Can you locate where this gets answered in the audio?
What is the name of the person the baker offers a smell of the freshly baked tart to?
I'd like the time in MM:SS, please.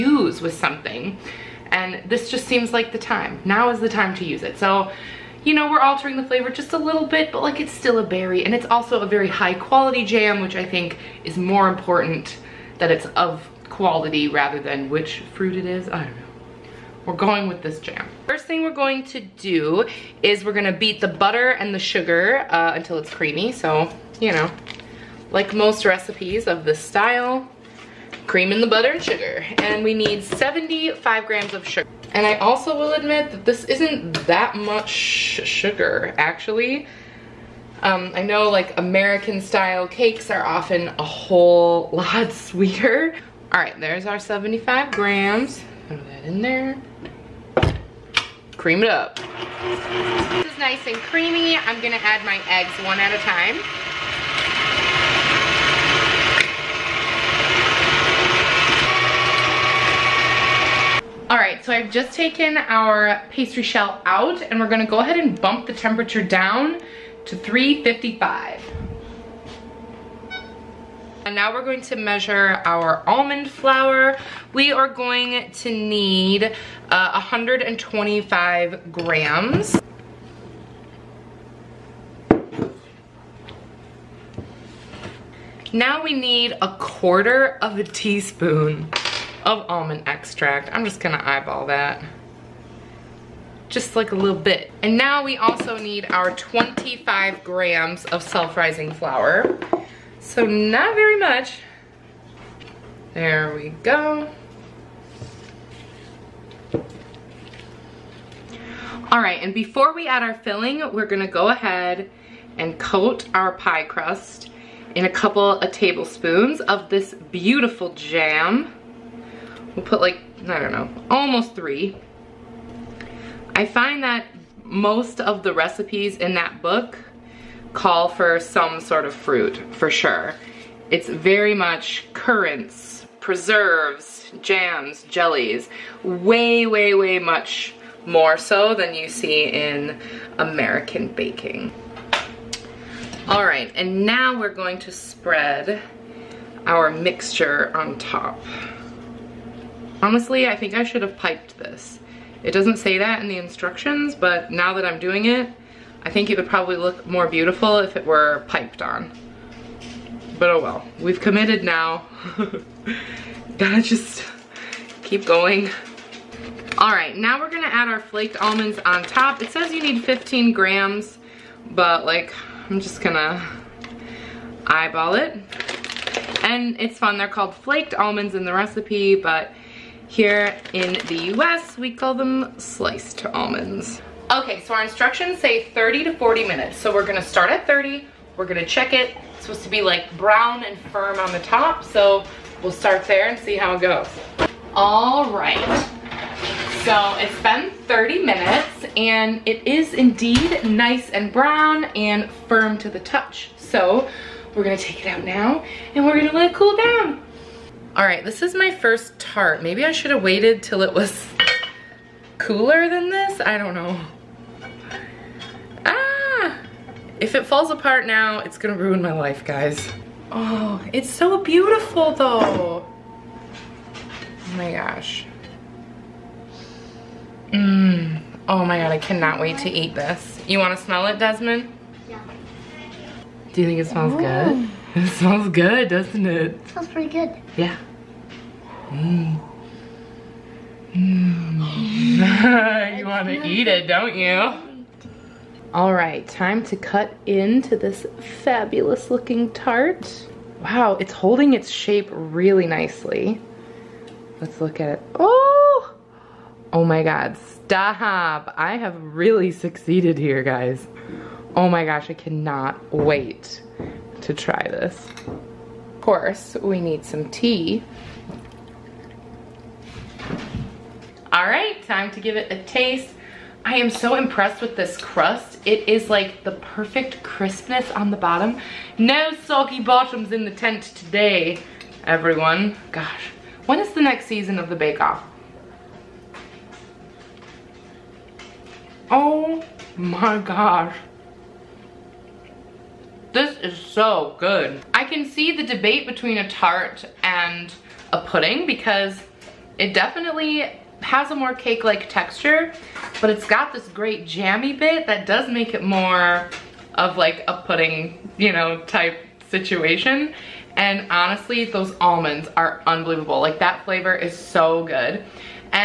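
03:51.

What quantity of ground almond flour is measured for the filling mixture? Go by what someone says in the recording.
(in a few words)
125 grams.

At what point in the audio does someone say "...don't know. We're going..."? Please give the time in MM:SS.
00:16.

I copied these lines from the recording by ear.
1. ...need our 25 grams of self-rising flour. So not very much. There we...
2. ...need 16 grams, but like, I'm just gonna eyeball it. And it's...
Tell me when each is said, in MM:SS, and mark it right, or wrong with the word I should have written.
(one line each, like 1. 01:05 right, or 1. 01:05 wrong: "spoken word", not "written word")
1. 01:35 right
2. 02:49 wrong: "15", not "16".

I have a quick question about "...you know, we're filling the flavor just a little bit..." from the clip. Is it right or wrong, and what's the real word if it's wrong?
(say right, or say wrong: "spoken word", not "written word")
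wrong: "altering", not "filling".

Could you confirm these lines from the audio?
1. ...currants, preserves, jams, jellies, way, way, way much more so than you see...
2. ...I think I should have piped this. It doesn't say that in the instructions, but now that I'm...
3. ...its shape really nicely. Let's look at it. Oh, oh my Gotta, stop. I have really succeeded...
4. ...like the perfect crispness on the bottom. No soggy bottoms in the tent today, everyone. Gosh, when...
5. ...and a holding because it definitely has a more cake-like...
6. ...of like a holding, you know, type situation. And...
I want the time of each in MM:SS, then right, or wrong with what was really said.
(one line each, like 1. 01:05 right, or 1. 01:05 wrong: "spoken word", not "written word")
1. 02:12 right
2. 02:30 right
3. 04:11 wrong: "God", not "Gotta"
4. 04:36 right
5. 04:57 wrong: "pudding", not "holding"
6. 05:06 wrong: "pudding", not "holding".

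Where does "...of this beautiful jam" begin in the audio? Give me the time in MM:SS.
01:56.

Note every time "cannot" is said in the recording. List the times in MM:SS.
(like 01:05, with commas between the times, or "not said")
03:48, 04:22.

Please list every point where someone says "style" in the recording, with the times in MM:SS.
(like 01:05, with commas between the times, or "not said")
00:26, 00:39.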